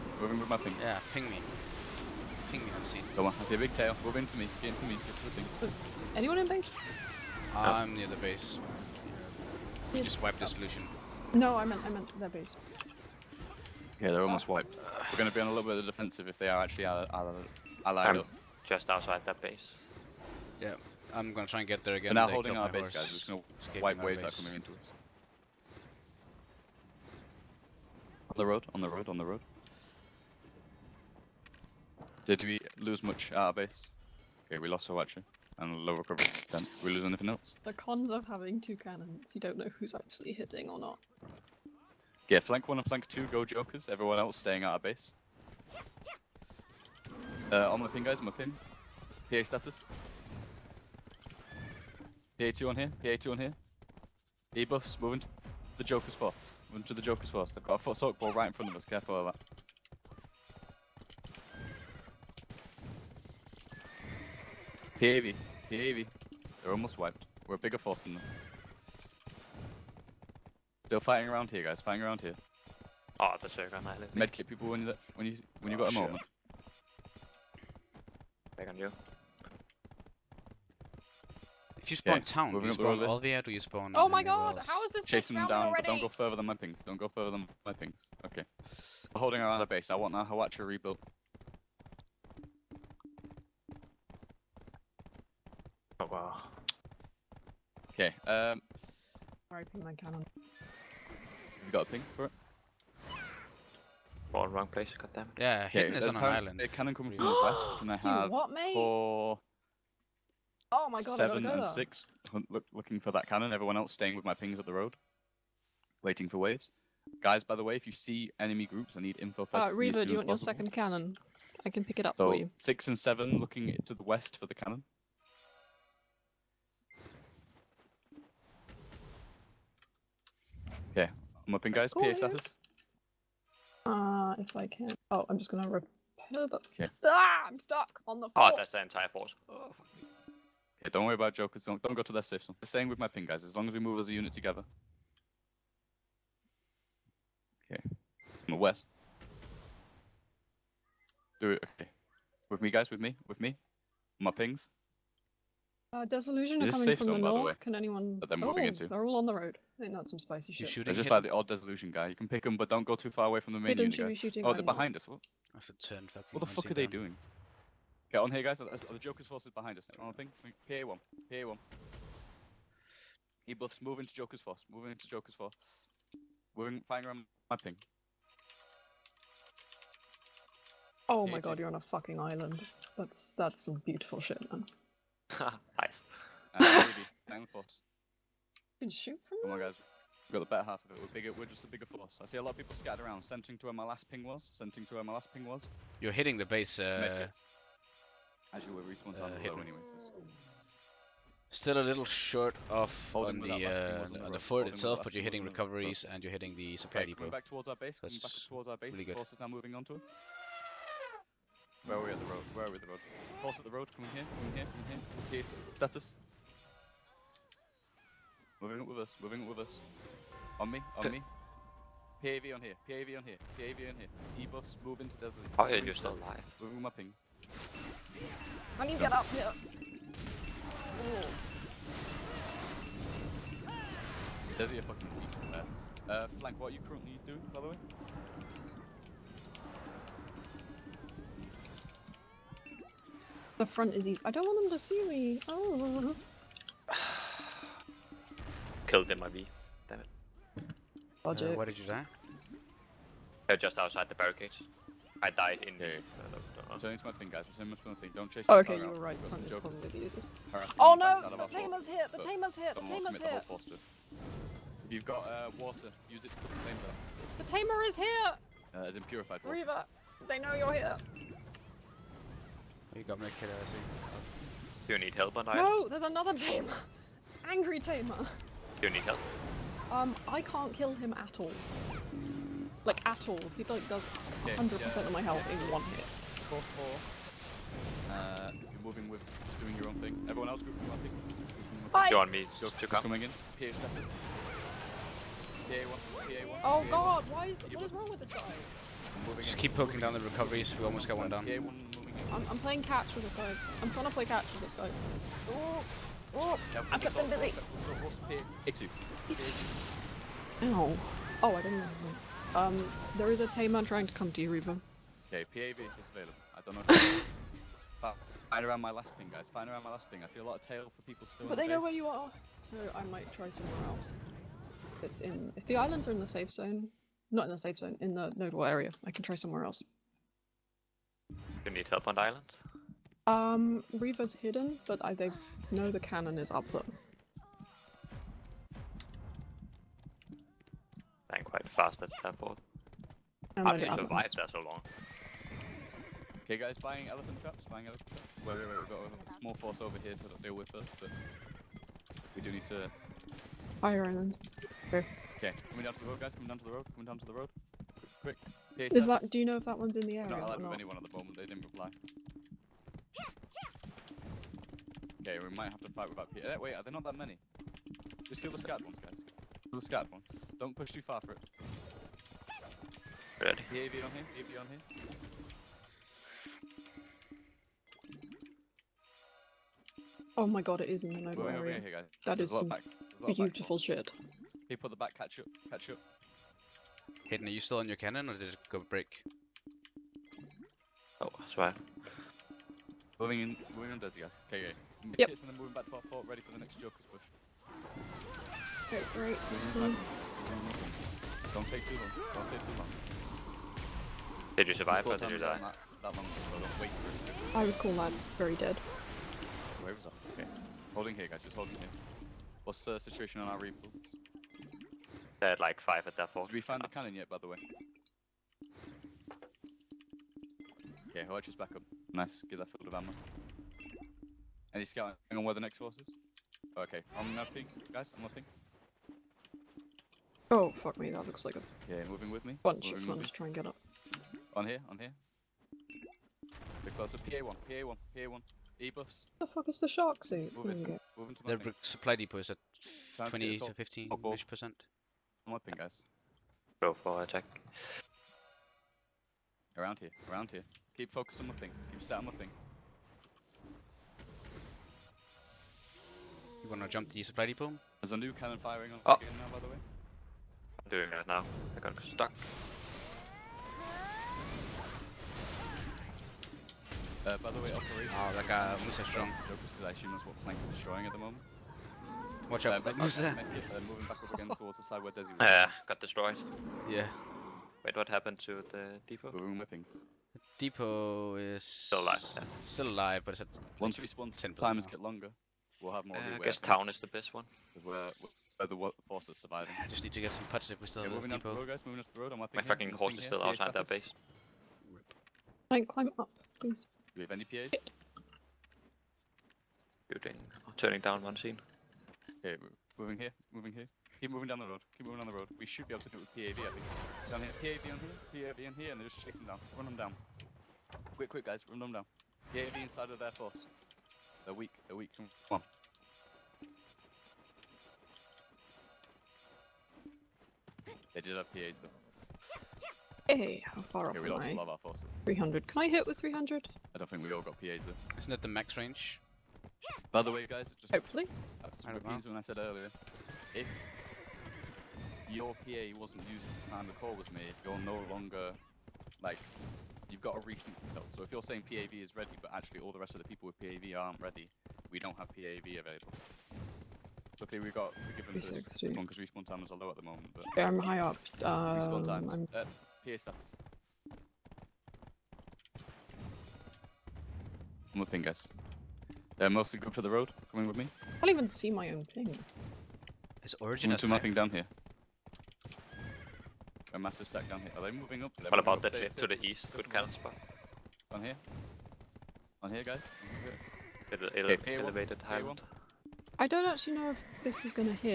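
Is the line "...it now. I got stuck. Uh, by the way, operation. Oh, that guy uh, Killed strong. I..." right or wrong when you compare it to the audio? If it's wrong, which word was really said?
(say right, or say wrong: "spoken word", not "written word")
wrong: "Musa", not "Killed".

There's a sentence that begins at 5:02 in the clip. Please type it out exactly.
I'm, I'm playing catch with this guy.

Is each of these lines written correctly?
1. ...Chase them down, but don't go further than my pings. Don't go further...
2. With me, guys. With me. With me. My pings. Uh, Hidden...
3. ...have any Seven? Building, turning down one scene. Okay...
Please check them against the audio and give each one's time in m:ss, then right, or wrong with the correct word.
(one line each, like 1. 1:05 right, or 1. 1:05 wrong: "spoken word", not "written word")
1. 1:25 right
2. 2:32 wrong: "Disillusion", not "Hidden"
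3. 8:17 wrong: "PAs", not "Seven".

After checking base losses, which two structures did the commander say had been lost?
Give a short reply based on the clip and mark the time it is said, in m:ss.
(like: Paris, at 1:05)
watcher and lower cover, at 0:34.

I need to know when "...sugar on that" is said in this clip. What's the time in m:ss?
1:13.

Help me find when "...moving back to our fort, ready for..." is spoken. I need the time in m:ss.
6:35.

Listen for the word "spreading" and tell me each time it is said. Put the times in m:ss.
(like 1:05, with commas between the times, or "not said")
not said.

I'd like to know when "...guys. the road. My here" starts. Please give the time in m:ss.
8:11.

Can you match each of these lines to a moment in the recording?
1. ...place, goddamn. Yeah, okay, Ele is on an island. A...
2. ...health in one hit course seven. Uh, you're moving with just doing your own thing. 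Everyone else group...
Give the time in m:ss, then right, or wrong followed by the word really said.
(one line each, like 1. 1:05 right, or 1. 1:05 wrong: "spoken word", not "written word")
1. 1:44 wrong: "Hidden", not "Ele"
2. 4:45 wrong: "four", not "seven".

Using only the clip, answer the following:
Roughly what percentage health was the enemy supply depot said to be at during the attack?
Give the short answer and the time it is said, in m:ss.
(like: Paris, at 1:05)
15 to 20 percent, at 7:23.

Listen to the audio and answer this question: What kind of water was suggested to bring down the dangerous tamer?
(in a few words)
purified water.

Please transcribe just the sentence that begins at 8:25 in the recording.
We should be able to do it with PAV, I think.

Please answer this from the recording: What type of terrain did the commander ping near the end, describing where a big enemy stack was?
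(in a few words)
elevated Highland.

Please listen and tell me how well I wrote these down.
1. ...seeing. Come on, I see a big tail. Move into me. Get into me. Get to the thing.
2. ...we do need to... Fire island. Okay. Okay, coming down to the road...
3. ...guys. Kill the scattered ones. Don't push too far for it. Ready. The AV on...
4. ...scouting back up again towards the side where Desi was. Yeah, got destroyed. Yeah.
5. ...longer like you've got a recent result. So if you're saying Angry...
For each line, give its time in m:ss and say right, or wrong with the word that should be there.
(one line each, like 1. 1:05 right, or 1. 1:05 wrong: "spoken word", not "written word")
1. 0:02 right
2. 5:52 right
3. 6:09 right
4. 7:53 wrong: "moving", not "scouting"
5. 8:58 wrong: "PAV", not "Angry".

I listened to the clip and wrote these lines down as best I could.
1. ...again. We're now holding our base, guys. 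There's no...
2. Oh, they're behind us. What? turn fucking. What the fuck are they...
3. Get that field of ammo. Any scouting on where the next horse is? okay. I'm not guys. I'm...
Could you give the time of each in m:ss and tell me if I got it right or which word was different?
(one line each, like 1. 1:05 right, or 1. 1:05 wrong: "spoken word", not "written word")
1. 0:21 right
2. 2:44 right
3. 7:02 right.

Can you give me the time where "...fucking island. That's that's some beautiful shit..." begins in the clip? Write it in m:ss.
3:01.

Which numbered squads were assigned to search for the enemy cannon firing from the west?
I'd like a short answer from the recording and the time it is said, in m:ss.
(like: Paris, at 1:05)
Seven and six, at 1:51.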